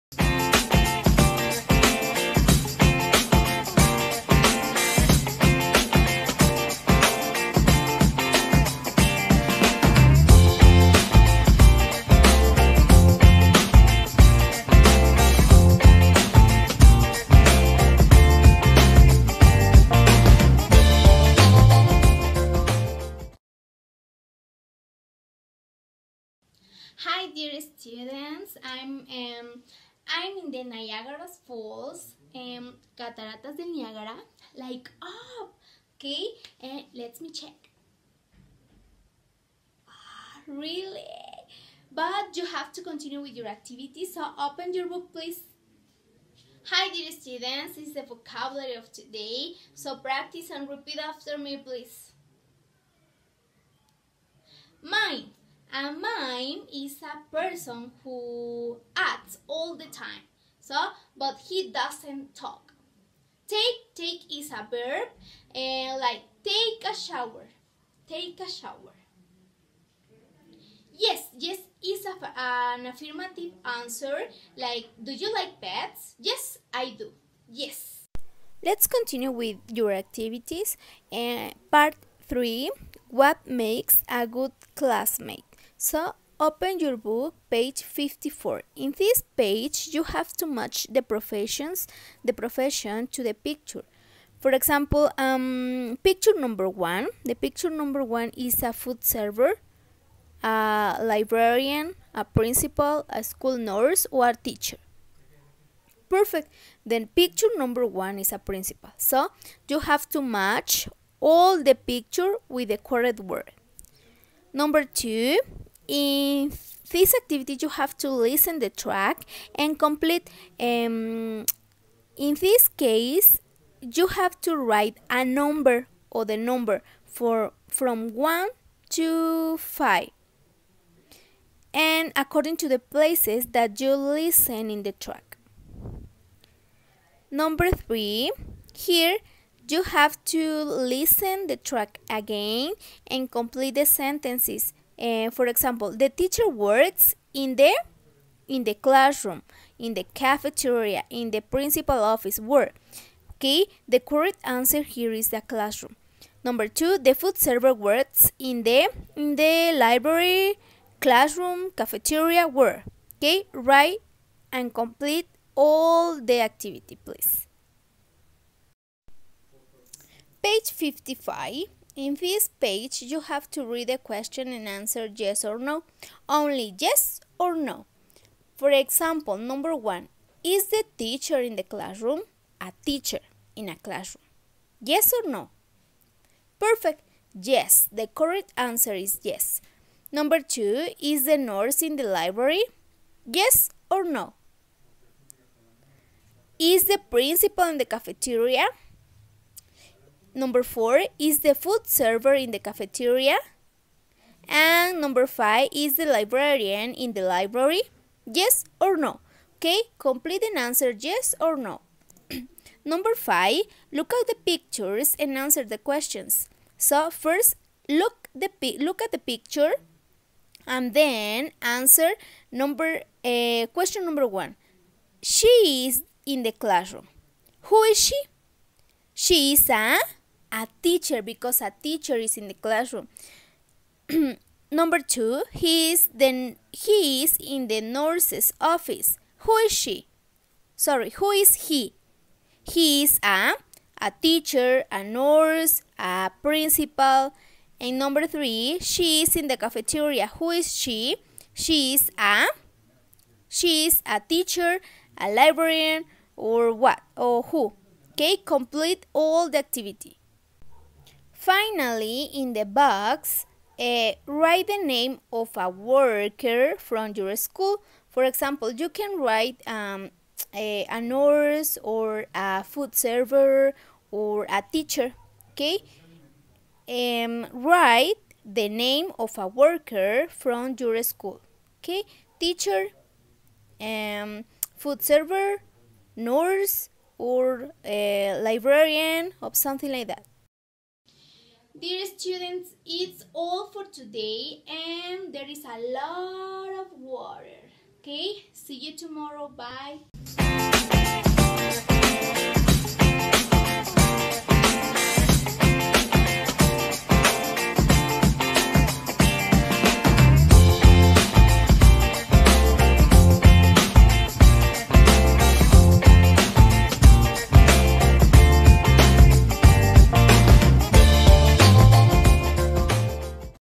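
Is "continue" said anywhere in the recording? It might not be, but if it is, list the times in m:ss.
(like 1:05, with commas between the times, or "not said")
0:42, 1:18.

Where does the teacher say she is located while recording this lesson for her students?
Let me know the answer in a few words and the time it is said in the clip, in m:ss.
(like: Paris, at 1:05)
Niagara Falls, at 0:30.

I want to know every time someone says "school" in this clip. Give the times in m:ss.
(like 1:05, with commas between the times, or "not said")
1:43, 4:27, 4:41.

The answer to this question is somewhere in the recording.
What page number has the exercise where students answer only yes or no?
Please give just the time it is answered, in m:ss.
2:50.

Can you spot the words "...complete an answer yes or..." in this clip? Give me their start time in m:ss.
3:29.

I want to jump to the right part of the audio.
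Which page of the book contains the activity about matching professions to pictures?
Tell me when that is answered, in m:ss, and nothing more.
1:27.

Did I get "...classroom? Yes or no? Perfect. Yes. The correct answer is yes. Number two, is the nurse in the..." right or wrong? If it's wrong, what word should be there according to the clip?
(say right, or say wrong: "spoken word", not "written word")
right.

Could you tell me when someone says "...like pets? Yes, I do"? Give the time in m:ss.
1:15.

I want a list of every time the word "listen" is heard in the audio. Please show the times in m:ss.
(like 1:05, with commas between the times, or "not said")
1:58, 2:13, 2:20.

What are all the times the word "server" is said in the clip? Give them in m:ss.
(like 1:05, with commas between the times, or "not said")
1:39, 2:37, 3:21, 4:32, 4:45.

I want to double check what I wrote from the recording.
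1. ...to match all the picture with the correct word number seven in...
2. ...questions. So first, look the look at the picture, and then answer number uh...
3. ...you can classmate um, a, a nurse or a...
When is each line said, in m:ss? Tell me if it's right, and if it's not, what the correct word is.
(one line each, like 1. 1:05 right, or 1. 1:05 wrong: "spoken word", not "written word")
1. 1:50 wrong: "two", not "seven"
2. 3:35 right
3. 4:28 wrong: "write", not "classmate".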